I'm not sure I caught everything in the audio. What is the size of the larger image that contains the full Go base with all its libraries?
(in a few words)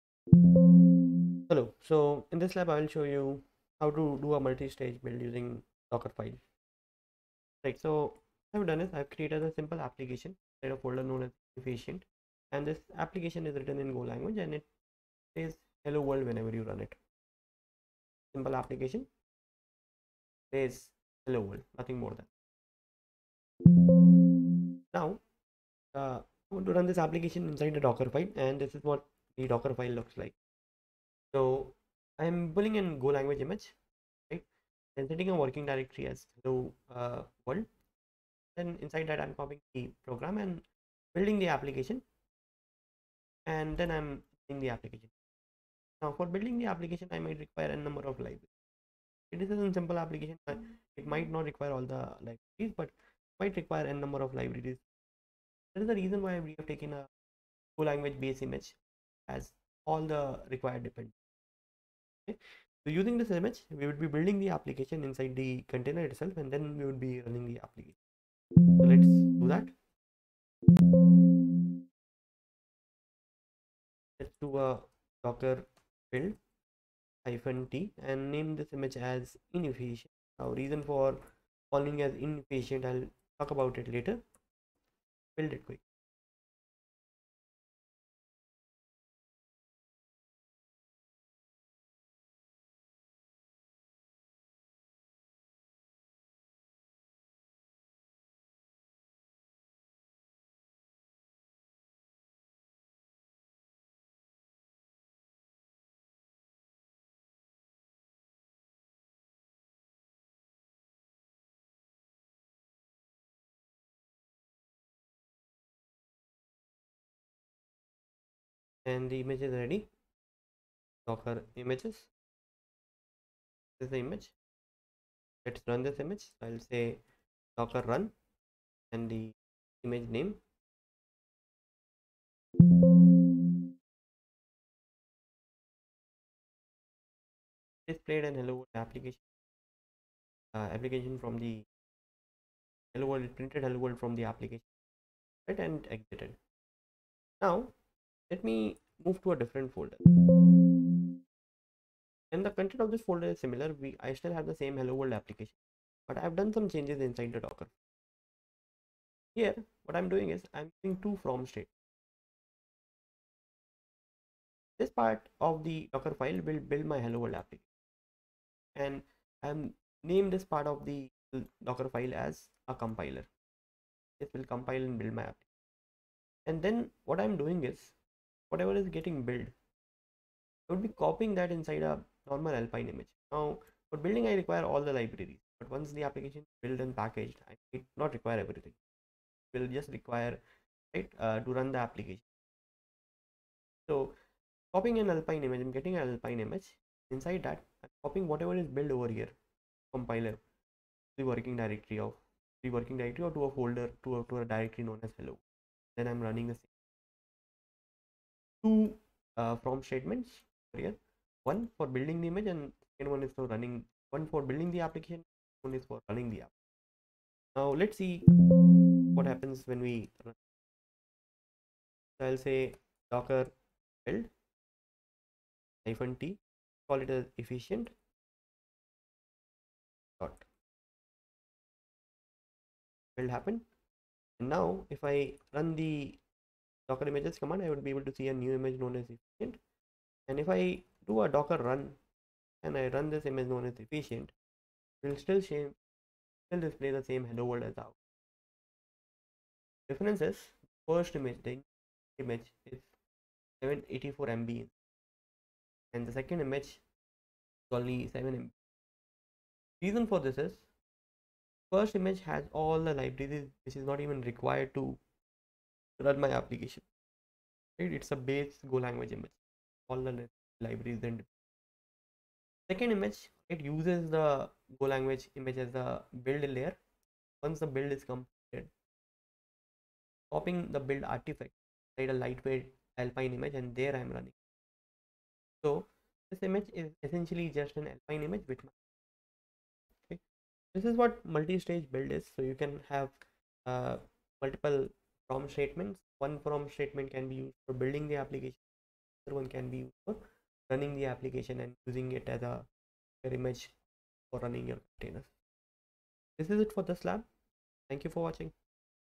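784 MB.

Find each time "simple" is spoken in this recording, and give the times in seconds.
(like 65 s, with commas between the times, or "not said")
9 s, 18 s, 49 s.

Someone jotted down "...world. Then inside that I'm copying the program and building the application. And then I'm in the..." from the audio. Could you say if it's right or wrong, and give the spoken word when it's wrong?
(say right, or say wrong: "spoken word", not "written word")
right.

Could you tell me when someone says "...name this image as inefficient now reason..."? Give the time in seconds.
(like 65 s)
78 s.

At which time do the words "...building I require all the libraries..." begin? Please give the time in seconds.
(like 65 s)
184 s.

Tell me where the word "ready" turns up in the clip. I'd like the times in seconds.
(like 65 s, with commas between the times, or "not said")
119 s.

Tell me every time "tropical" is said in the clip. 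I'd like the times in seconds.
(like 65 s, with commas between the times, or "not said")
not said.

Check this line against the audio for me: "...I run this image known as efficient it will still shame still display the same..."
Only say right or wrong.
right.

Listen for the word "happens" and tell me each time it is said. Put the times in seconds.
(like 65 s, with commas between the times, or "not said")
219 s, 233 s.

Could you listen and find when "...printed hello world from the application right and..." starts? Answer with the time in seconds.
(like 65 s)
143 s.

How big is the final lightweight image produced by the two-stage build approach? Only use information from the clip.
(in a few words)
7 MB.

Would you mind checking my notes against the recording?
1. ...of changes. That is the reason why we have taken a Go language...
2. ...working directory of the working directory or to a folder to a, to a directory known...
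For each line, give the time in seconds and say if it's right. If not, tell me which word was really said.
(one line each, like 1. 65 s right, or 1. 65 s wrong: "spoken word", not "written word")
1. 54 s wrong: "libraries", not "changes"
2. 201 s right.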